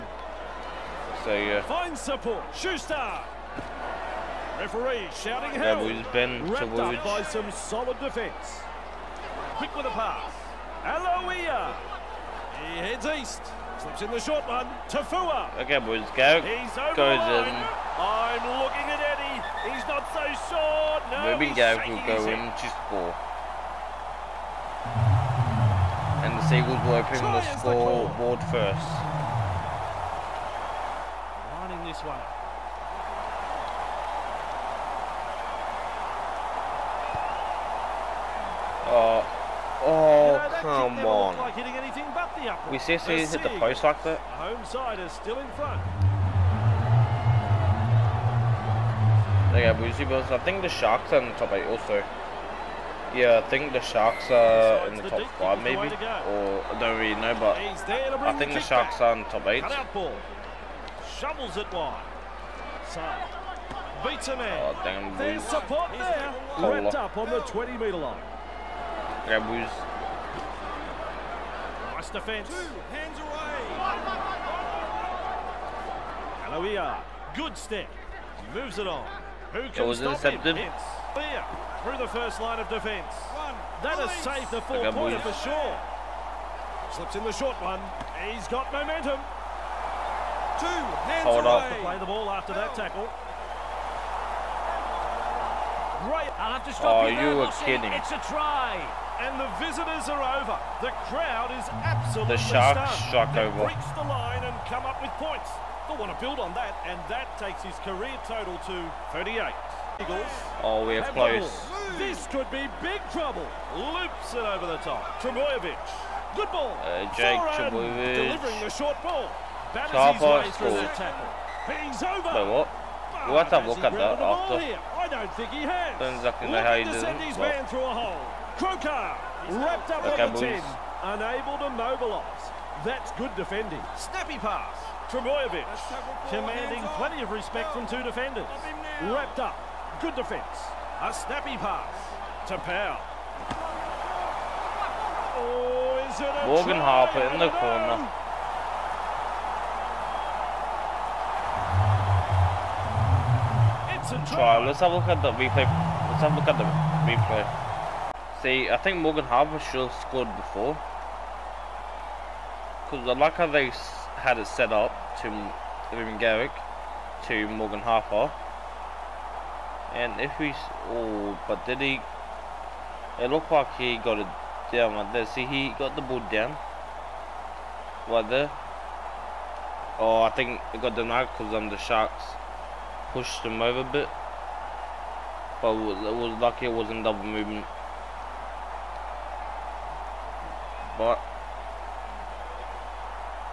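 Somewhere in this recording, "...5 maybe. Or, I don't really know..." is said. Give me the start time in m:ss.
0:55.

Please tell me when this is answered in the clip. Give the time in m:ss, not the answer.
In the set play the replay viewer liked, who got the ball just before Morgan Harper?
2:45.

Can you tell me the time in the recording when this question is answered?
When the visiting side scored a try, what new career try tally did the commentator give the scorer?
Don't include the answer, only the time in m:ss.
1:49.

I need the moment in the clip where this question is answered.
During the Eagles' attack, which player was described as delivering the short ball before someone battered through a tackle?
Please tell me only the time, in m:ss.
1:57.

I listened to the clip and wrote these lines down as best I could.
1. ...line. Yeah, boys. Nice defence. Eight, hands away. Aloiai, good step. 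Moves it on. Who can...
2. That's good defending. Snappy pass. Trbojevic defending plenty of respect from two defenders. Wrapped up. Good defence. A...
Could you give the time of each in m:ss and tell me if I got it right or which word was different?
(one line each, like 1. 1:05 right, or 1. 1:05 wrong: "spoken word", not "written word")
1. 1:07 wrong: "Two", not "Eight"
2. 2:12 wrong: "commanding", not "defending".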